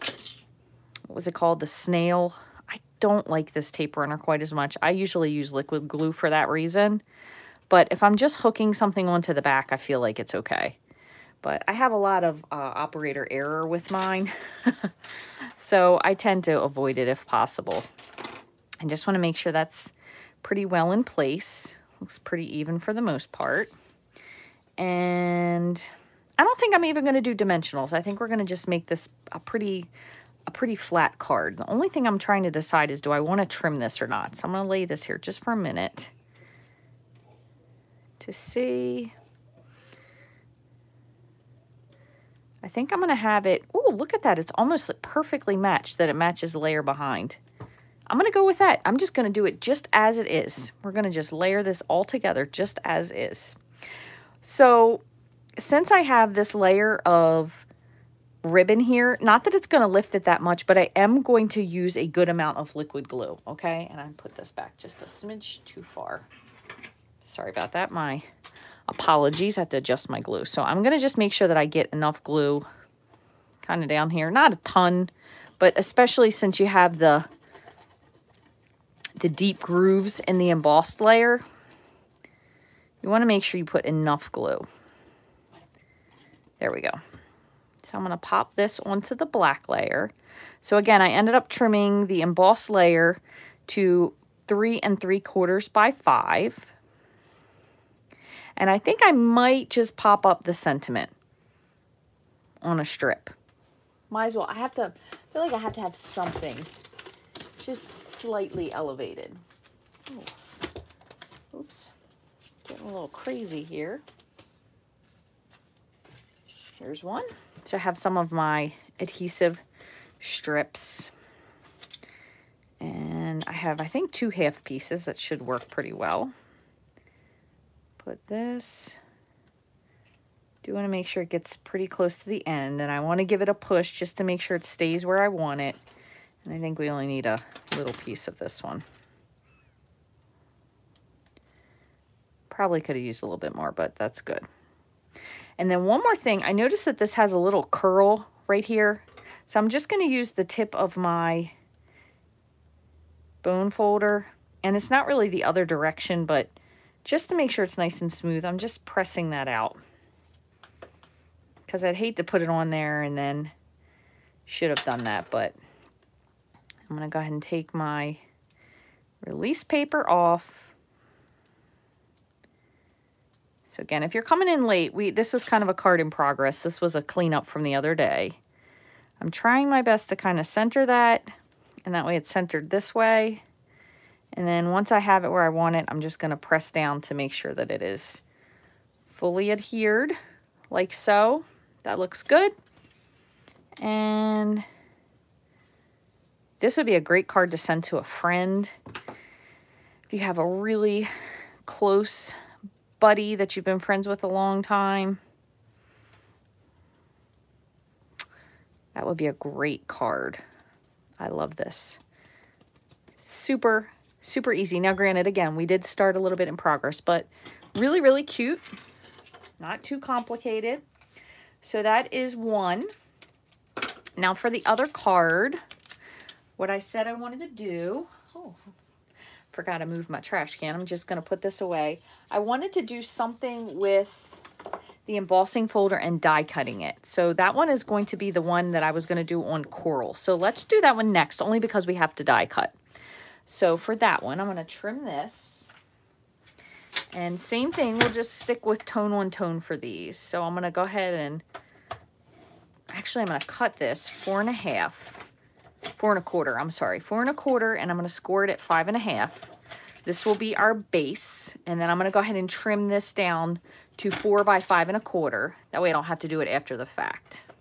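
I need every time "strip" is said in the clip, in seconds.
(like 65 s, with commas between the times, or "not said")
102 s, 120 s.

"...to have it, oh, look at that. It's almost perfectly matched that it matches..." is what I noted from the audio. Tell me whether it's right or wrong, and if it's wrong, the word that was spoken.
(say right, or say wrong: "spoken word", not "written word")
right.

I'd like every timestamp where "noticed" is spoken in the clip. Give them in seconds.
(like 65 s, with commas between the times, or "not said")
146 s.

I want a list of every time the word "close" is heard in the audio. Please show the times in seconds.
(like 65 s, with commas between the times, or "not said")
131 s, 201 s.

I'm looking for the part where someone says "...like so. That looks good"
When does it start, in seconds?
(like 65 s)
190 s.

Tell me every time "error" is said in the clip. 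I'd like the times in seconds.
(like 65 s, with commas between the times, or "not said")
13 s.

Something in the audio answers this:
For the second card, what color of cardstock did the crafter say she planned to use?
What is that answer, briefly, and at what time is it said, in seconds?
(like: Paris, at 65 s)
Coral, at 239 s.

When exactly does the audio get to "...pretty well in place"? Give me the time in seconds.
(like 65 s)
20 s.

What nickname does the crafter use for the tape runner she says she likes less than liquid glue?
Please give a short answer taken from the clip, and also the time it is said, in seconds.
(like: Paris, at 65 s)
The snail, at 1 s.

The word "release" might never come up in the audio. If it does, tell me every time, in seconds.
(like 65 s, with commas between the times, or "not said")
169 s.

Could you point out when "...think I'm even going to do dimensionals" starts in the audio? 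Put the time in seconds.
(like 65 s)
26 s.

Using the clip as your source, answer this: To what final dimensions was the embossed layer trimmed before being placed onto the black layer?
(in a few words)
3 3/4 by 5.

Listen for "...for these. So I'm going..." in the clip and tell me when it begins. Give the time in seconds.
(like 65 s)
249 s.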